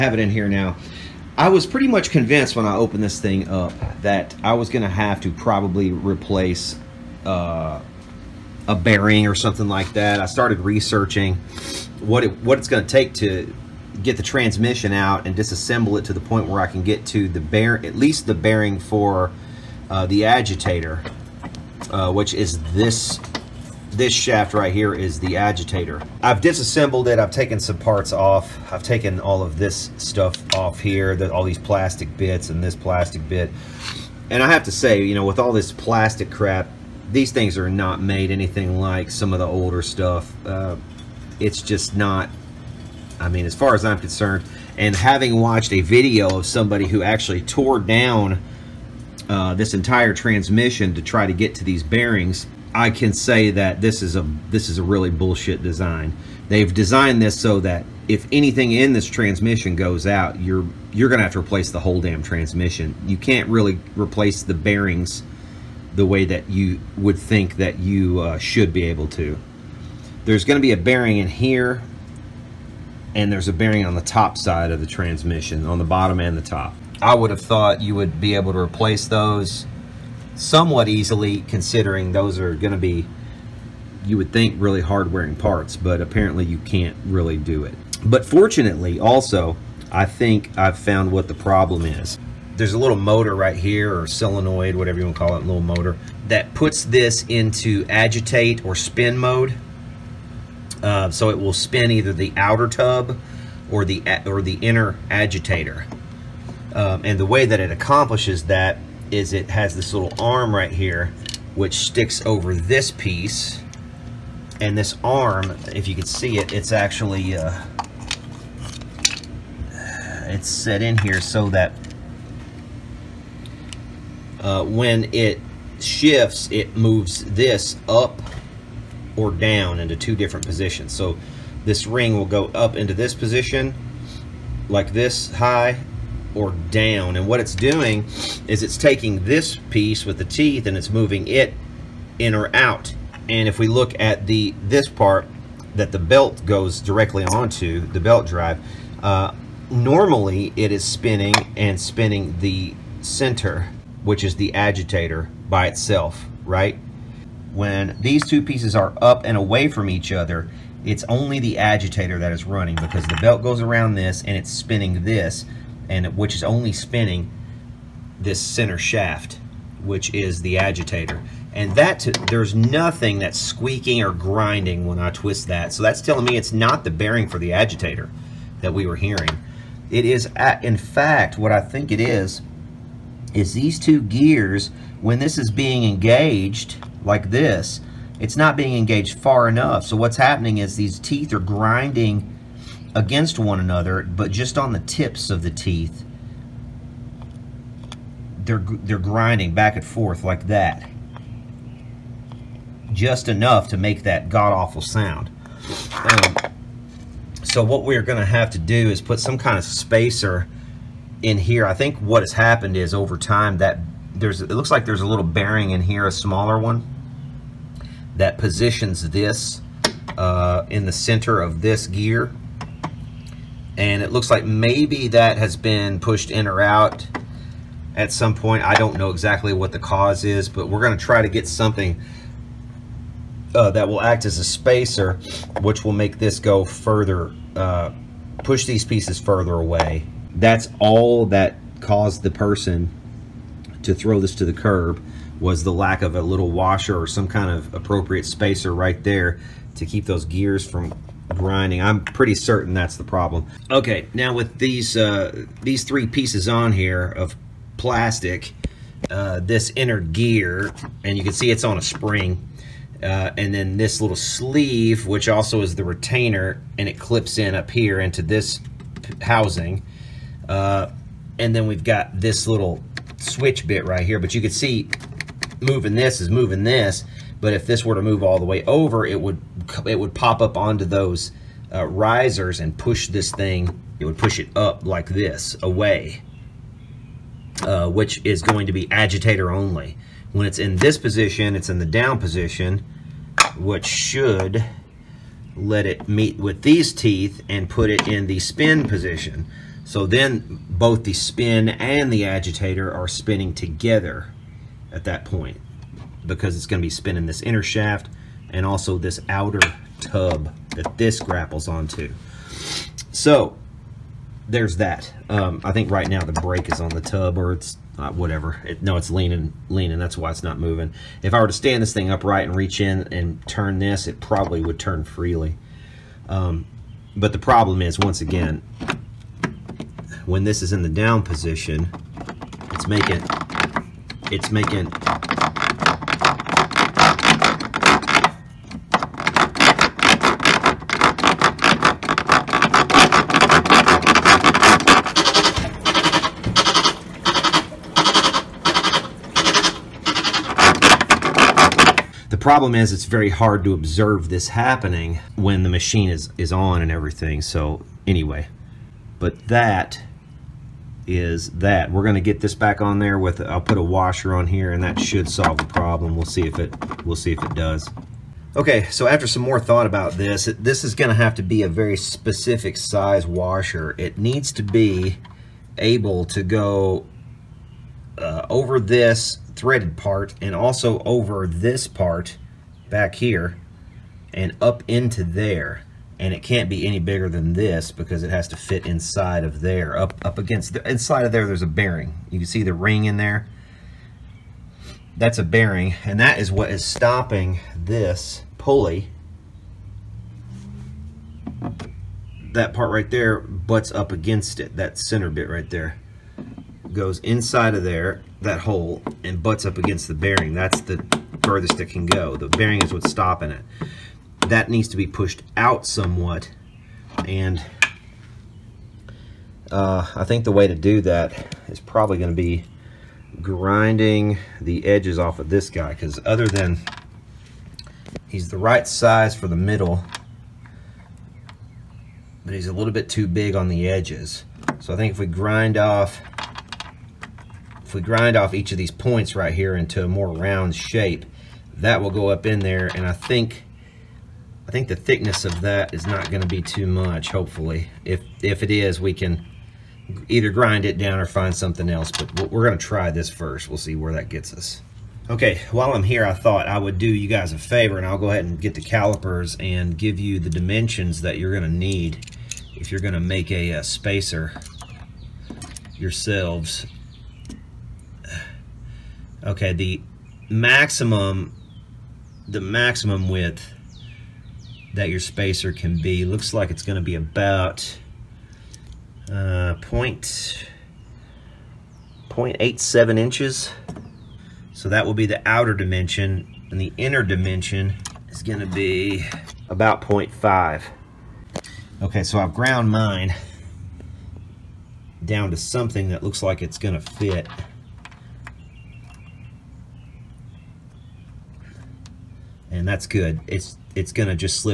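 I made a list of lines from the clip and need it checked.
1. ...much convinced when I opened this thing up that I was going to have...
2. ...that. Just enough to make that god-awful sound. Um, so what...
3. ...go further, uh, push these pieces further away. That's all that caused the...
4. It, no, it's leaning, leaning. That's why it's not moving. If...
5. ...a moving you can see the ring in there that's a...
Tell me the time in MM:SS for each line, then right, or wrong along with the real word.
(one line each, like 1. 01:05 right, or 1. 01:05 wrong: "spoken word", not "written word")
1. 00:01 right
2. 03:20 right
3. 03:56 right
4. 05:18 right
5. 06:31 wrong: "bearing", not "moving".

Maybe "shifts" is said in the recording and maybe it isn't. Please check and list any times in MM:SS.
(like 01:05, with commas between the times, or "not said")
02:05.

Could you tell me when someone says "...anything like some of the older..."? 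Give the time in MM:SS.
00:38.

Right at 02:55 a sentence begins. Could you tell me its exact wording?
So that's telling me it's not the bearing for the agitator that we were hearing.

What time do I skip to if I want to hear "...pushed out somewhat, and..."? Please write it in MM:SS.
06:55.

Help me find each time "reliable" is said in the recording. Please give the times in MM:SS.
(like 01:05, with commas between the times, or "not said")
not said.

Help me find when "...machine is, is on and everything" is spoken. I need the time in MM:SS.
05:55.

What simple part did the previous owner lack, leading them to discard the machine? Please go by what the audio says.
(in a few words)
a little washer.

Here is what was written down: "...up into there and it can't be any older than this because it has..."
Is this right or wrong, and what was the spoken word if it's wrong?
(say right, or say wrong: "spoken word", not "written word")
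wrong: "bigger", not "older".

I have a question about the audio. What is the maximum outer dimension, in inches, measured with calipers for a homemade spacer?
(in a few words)
0.87 inches.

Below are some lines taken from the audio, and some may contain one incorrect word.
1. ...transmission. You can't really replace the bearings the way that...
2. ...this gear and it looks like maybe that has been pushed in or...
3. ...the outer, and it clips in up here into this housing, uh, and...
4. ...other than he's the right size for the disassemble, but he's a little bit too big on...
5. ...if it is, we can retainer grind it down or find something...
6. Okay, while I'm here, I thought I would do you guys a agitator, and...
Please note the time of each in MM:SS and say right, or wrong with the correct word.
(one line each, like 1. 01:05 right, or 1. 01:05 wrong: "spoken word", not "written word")
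1. 01:02 right
2. 03:41 right
3. 04:25 wrong: "retainer", not "outer"
4. 07:06 wrong: "middle", not "disassemble"
5. 07:28 wrong: "either", not "retainer"
6. 07:35 wrong: "favor", not "agitator".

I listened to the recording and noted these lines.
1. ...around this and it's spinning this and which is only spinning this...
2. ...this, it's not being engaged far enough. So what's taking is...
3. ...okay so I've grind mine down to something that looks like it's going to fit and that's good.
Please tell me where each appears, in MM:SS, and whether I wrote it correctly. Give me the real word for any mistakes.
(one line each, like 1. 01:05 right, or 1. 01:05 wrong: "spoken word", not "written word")
1. 02:43 right
2. 03:07 wrong: "happening", not "taking"
3. 08:12 wrong: "ground", not "grind".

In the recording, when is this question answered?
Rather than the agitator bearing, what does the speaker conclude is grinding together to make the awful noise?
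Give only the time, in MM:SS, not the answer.
03:03.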